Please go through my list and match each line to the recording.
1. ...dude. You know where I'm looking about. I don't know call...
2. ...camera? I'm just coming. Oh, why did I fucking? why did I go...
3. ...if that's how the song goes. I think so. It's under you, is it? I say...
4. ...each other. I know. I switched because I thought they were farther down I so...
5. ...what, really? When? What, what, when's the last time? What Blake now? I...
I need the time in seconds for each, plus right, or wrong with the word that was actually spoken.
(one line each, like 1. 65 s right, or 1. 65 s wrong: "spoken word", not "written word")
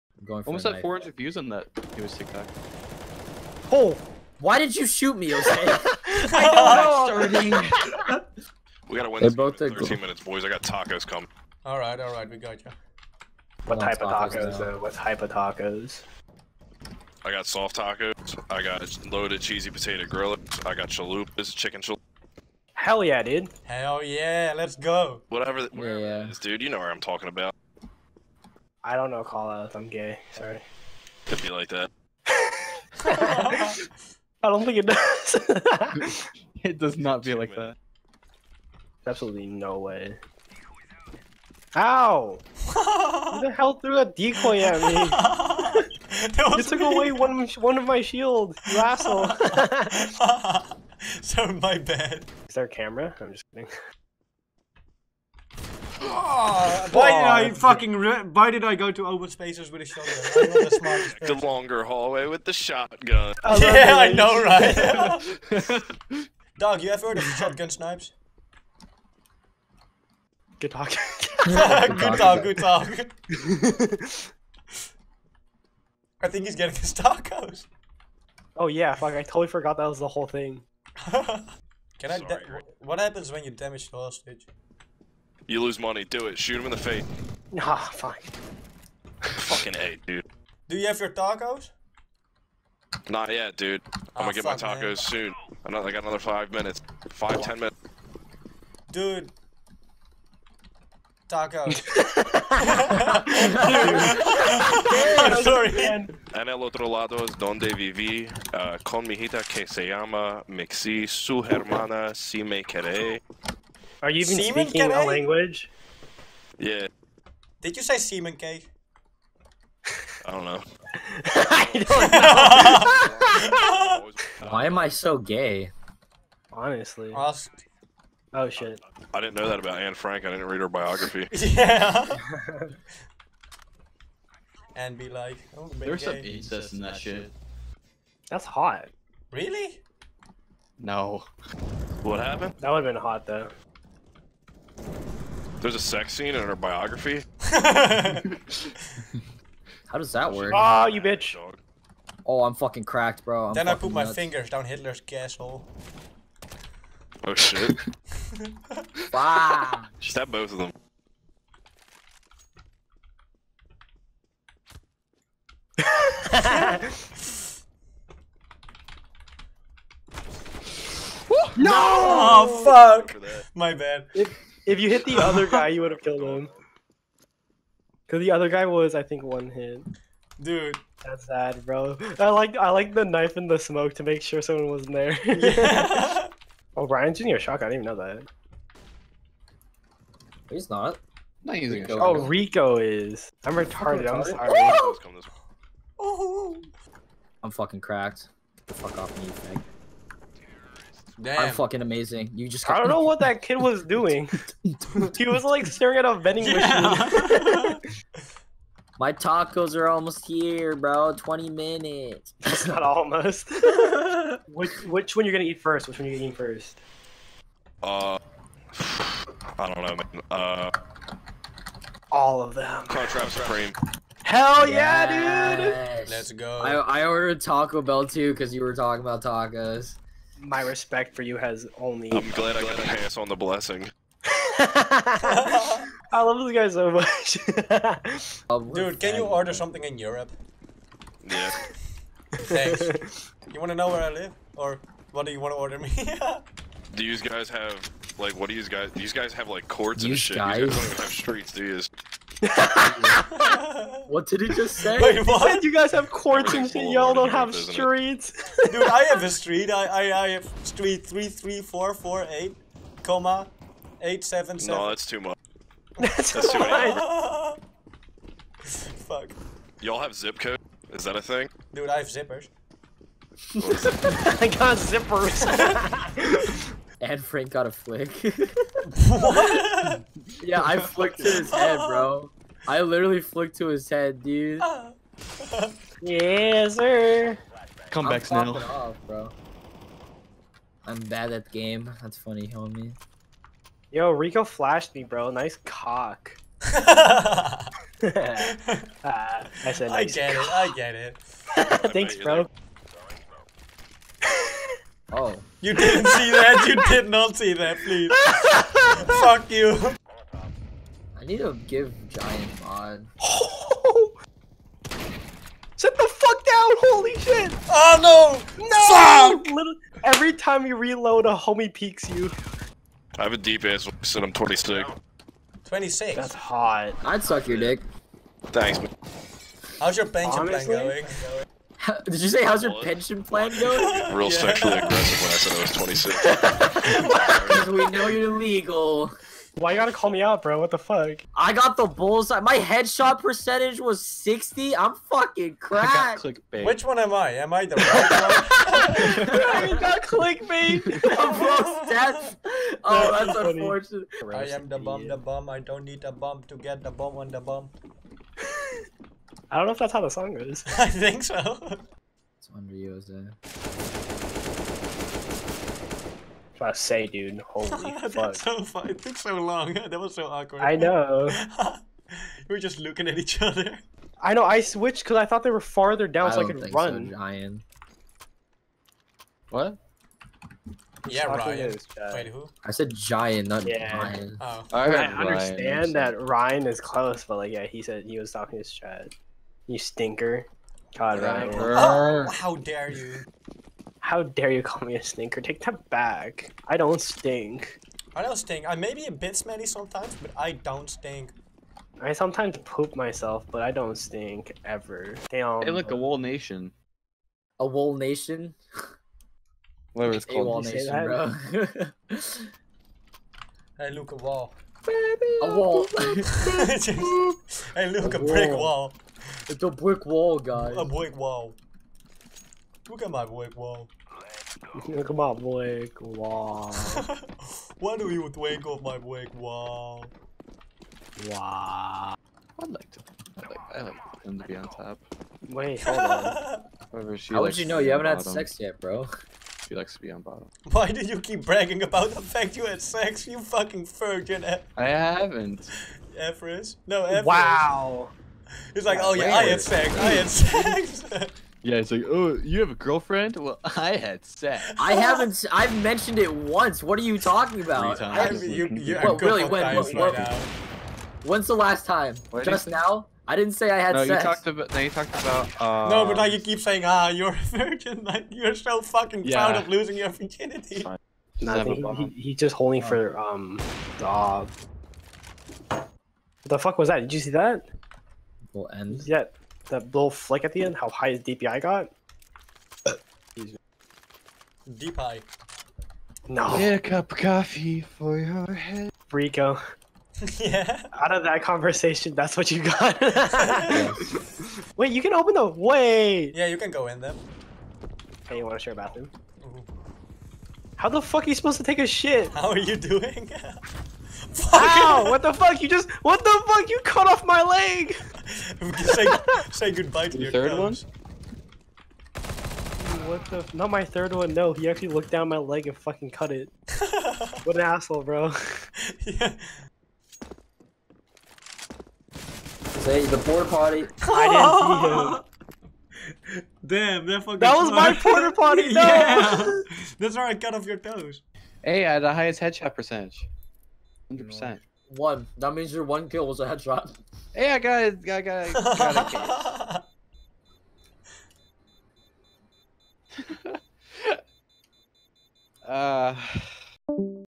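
1. 26 s wrong: "talking", not "looking"
2. 52 s wrong: "kidding", not "coming"
3. 359 s right
4. 373 s right
5. 458 s wrong: "Just", not "Blake".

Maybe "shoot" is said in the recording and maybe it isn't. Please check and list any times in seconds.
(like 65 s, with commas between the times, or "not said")
4 s, 86 s.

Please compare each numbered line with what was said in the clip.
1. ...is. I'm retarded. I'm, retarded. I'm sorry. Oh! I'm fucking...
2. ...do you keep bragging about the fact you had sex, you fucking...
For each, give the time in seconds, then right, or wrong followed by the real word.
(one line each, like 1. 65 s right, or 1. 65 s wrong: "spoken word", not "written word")
1. 193 s right
2. 440 s right.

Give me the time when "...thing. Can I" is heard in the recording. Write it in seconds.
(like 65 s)
80 s.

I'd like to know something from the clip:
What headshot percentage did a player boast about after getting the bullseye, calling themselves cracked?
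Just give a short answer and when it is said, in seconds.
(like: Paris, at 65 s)
60, at 344 s.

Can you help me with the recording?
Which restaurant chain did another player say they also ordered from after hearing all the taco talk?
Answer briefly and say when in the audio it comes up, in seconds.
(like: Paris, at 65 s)
Taco Bell, at 227 s.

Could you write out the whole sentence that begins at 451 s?
Yeah, it's like, oh, you have a girlfriend?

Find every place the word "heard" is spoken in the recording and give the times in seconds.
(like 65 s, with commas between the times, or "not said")
67 s.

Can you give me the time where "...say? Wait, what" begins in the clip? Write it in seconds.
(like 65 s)
254 s.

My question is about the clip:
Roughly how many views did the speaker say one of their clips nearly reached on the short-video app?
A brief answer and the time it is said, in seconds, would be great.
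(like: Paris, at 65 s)
400, at 0 s.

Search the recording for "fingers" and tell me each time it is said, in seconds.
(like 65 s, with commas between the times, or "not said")
154 s.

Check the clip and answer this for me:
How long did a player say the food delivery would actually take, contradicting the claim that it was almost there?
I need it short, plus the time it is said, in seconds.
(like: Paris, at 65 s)
20 minutes, at 211 s.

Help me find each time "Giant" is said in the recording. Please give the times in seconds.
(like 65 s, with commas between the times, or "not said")
312 s, 382 s.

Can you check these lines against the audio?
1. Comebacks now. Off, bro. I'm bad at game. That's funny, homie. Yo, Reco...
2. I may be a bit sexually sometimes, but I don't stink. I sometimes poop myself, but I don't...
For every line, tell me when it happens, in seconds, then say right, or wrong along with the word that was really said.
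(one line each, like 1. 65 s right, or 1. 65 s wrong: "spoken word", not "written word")
1. 287 s right
2. 398 s wrong: "smelly", not "sexually".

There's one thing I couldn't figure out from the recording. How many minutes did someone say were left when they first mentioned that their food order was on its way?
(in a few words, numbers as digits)
13.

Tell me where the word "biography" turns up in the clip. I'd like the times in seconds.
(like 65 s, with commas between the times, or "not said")
130 s, 146 s.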